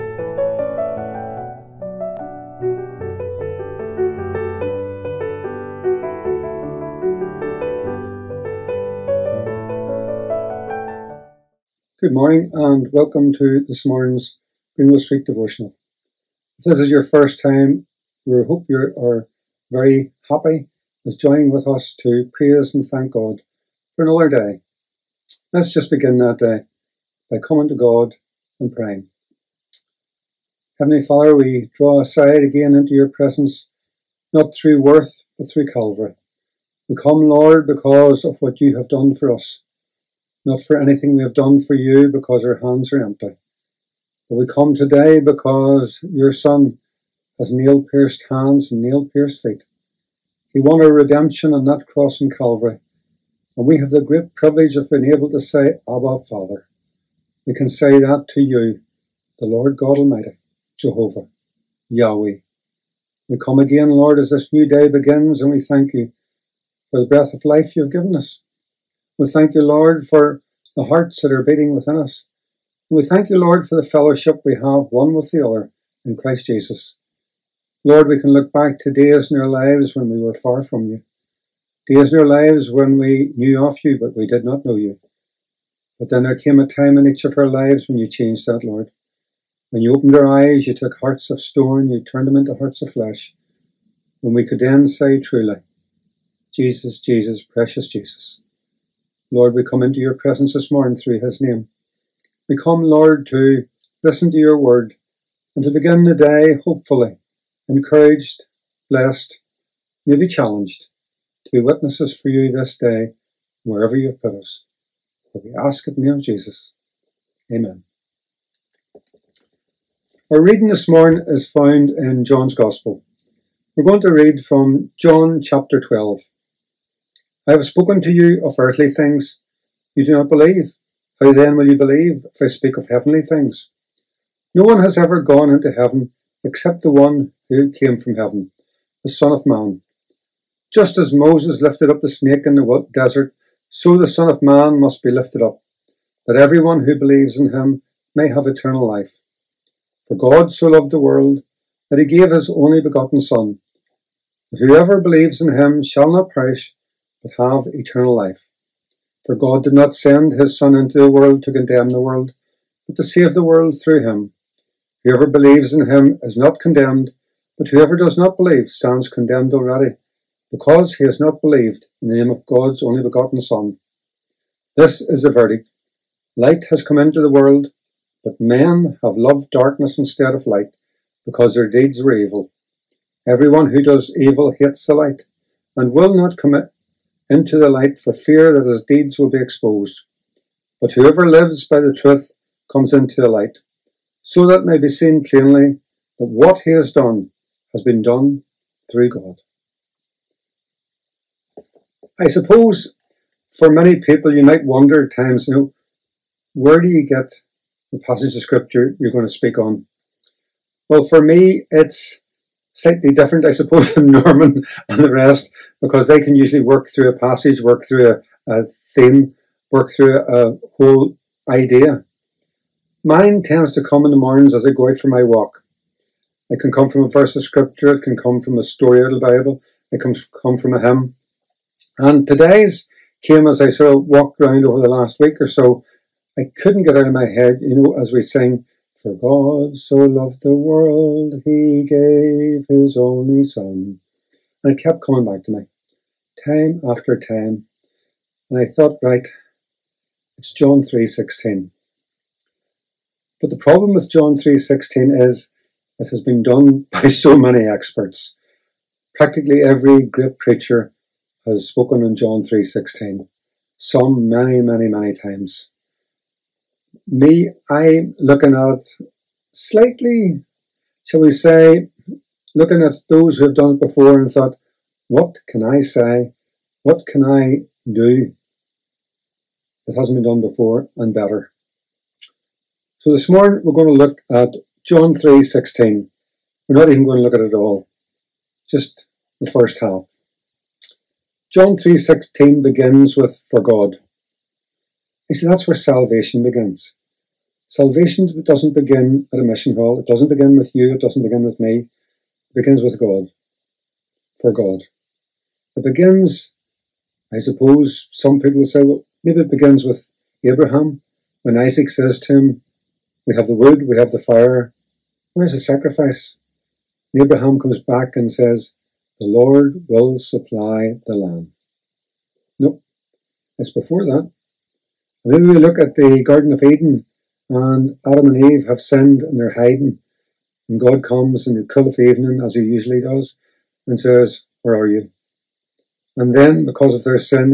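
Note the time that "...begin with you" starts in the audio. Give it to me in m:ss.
5:00.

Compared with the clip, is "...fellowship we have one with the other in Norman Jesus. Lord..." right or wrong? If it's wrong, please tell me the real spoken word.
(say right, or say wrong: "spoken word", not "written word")
wrong: "Christ", not "Norman".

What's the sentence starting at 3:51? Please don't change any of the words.
And today's came as I sort of walked around over the last week or so.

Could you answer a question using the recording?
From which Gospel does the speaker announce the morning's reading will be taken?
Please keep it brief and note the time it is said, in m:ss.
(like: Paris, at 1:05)
John's Gospel, at 2:02.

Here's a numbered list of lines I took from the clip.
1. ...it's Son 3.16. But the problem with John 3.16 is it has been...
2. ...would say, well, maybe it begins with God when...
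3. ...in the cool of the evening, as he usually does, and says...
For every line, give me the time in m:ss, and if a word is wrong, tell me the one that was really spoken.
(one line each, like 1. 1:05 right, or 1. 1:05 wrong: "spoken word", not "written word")
1. 4:10 wrong: "John", not "Son"
2. 5:08 wrong: "Abraham", not "God"
3. 5:31 right.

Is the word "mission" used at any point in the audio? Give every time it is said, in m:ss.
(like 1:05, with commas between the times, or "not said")
4:59.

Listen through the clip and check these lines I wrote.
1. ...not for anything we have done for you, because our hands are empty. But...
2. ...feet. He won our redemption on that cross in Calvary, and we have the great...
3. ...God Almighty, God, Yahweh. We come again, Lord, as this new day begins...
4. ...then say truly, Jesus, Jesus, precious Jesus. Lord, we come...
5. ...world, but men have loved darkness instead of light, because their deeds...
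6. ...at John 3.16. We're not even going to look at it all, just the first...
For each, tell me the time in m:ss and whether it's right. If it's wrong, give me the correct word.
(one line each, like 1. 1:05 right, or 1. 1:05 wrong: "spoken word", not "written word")
1. 0:40 right
2. 0:49 right
3. 0:59 wrong: "Jehovah", not "God"
4. 1:34 right
5. 2:57 right
6. 4:44 right.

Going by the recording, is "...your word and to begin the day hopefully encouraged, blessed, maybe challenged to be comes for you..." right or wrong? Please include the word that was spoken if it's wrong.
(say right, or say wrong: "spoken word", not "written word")
wrong: "witnesses", not "comes".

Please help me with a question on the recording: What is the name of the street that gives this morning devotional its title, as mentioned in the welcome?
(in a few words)
Greenwell Street.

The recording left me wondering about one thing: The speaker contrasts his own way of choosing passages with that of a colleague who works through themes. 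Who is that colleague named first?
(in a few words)
Norman.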